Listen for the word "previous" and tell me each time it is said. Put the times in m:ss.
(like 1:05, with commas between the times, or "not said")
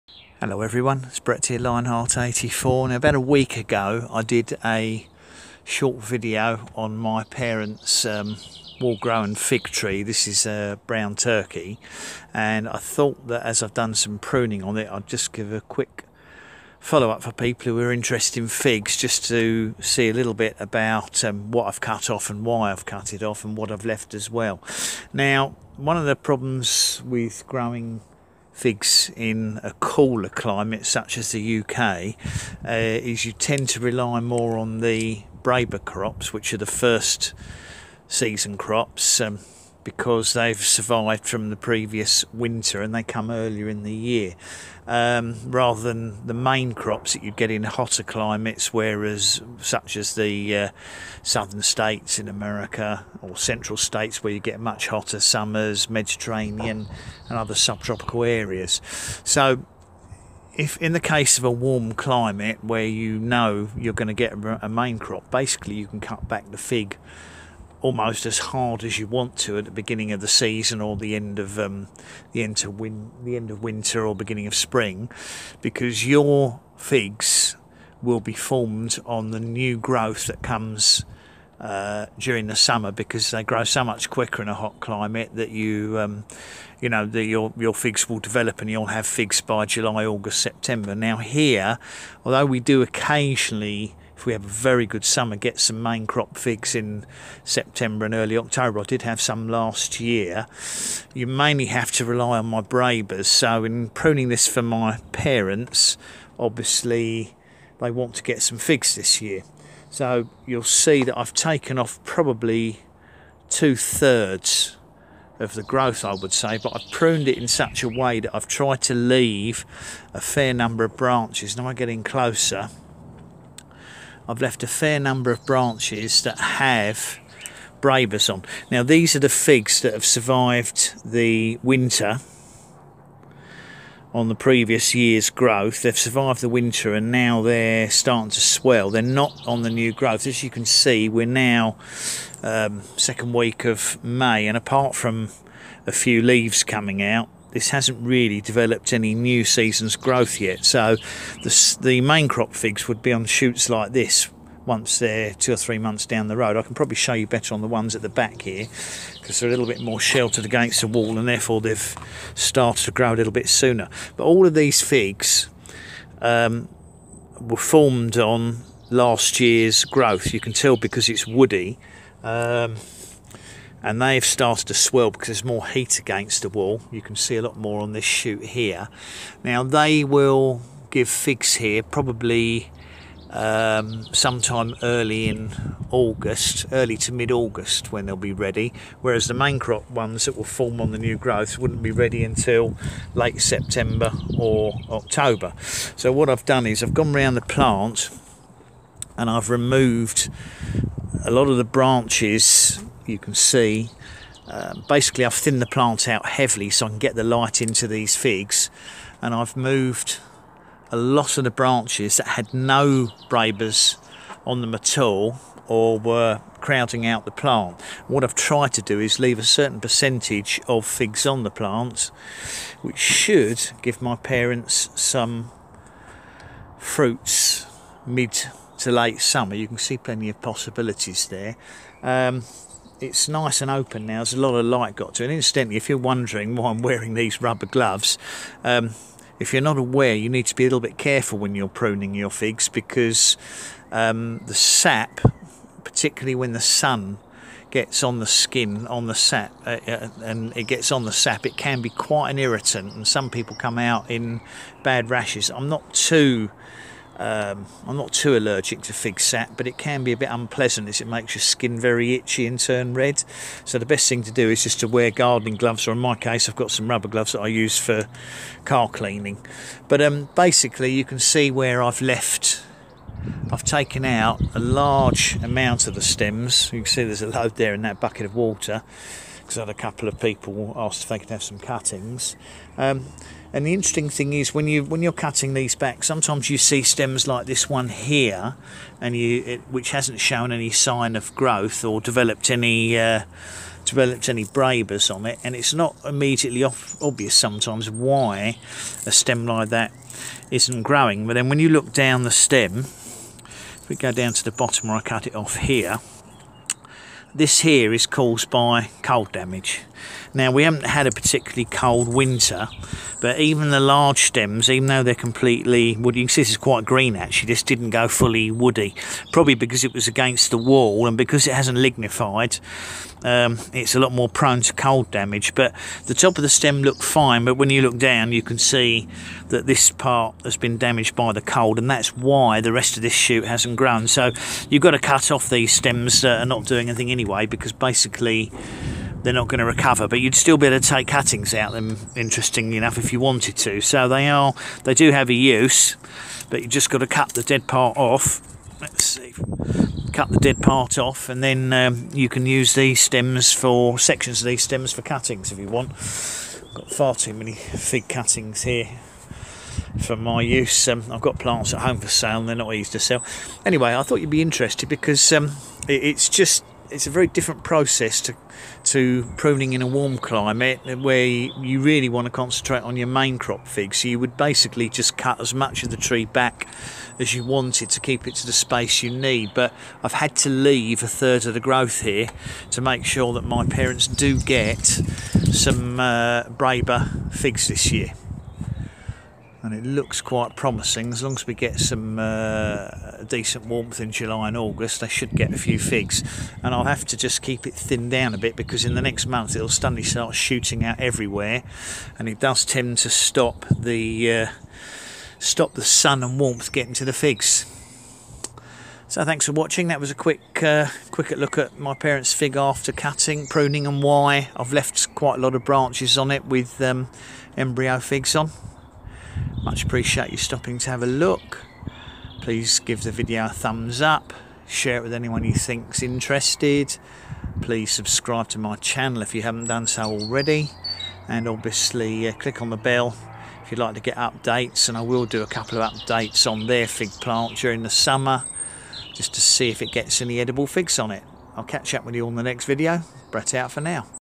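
0:41, 2:14.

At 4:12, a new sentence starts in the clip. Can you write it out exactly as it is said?
And some people come out in bad rashes.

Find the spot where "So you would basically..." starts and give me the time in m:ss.
6:13.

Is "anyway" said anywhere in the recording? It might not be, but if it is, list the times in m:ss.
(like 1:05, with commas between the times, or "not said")
5:37, 6:03.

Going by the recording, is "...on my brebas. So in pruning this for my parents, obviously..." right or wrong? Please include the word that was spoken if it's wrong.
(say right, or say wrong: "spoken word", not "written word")
right.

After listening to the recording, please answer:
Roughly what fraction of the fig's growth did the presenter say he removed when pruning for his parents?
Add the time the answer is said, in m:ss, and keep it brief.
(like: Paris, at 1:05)
two thirds, at 1:53.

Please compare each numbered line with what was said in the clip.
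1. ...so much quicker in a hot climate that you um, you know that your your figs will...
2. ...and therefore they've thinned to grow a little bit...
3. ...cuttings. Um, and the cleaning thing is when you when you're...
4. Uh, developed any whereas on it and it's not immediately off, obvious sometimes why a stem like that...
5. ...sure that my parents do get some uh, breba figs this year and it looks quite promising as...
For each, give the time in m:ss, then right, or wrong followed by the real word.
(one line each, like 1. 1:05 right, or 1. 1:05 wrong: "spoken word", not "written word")
1. 1:23 right
2. 2:41 wrong: "started", not "thinned"
3. 4:41 wrong: "interesting", not "cleaning"
4. 4:52 wrong: "brebas", not "whereas"
5. 6:23 right.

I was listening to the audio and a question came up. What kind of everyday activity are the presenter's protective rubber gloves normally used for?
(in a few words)
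car cleaning.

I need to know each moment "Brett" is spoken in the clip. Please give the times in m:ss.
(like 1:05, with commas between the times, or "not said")
0:01, 7:23.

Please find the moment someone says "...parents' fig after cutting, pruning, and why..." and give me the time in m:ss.
6:51.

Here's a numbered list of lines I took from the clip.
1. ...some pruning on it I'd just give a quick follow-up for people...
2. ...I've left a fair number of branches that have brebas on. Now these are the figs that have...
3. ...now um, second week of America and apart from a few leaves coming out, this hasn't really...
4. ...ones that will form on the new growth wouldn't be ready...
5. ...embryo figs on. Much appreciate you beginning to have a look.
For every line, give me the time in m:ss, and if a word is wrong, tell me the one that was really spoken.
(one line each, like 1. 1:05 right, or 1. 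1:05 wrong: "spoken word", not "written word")
1. 0:13 right
2. 2:04 right
3. 2:21 wrong: "May", not "America"
4. 3:09 right
5. 6:57 wrong: "stopping", not "beginning".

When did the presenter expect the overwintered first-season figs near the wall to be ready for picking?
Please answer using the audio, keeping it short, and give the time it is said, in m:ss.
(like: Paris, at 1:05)
early to mid-August, at 3:06.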